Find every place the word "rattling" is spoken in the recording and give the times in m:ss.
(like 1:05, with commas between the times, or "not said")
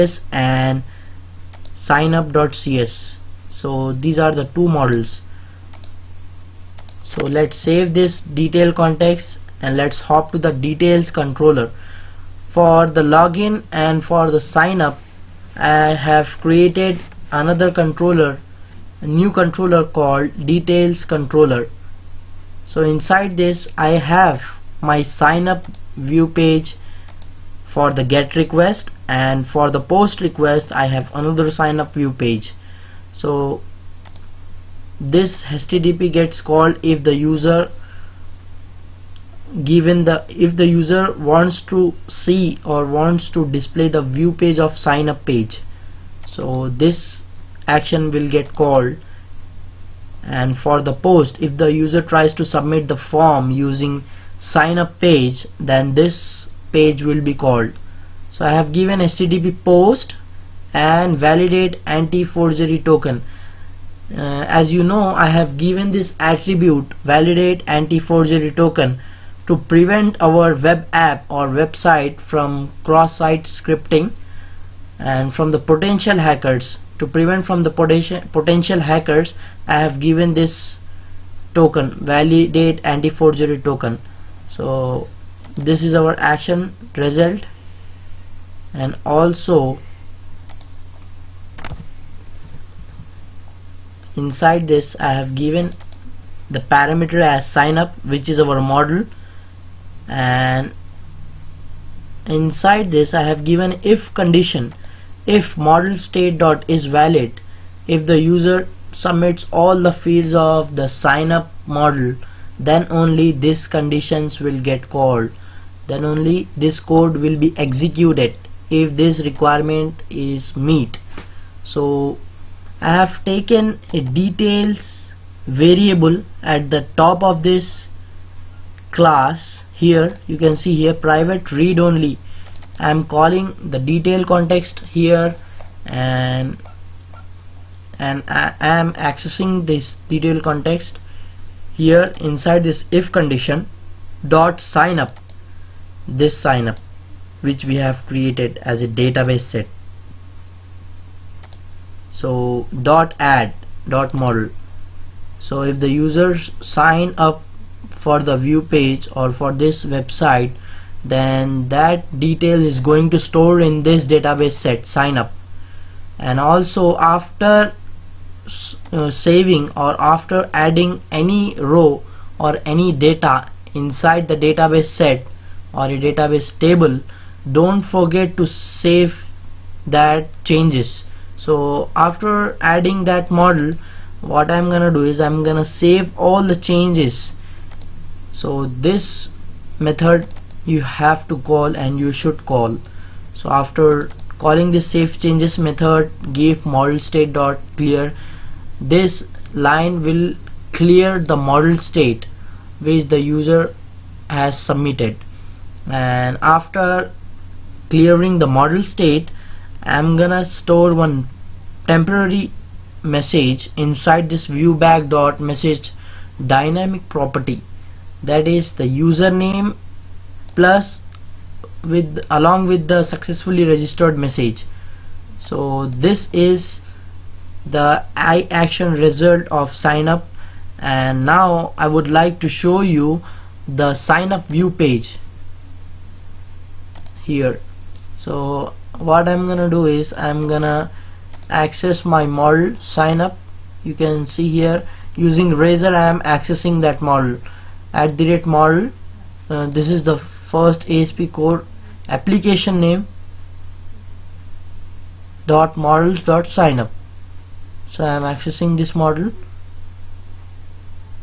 not said.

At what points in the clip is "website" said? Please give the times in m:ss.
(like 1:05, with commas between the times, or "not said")
1:11, 2:39.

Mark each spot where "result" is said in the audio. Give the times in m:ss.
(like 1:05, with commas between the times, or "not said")
1:26, 3:48.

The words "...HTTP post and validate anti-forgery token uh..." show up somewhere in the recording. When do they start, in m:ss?
0:58.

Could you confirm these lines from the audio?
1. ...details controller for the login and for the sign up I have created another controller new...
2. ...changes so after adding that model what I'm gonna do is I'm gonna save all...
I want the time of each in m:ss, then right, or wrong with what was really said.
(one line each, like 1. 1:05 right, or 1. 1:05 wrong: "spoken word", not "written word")
1. 0:10 right
2. 3:00 right.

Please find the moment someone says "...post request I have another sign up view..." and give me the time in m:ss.
0:29.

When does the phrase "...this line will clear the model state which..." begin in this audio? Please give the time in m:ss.
3:18.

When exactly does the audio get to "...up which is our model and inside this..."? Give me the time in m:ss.
1:37.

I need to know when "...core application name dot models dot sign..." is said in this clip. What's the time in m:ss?
4:11.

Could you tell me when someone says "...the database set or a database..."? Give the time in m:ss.
2:54.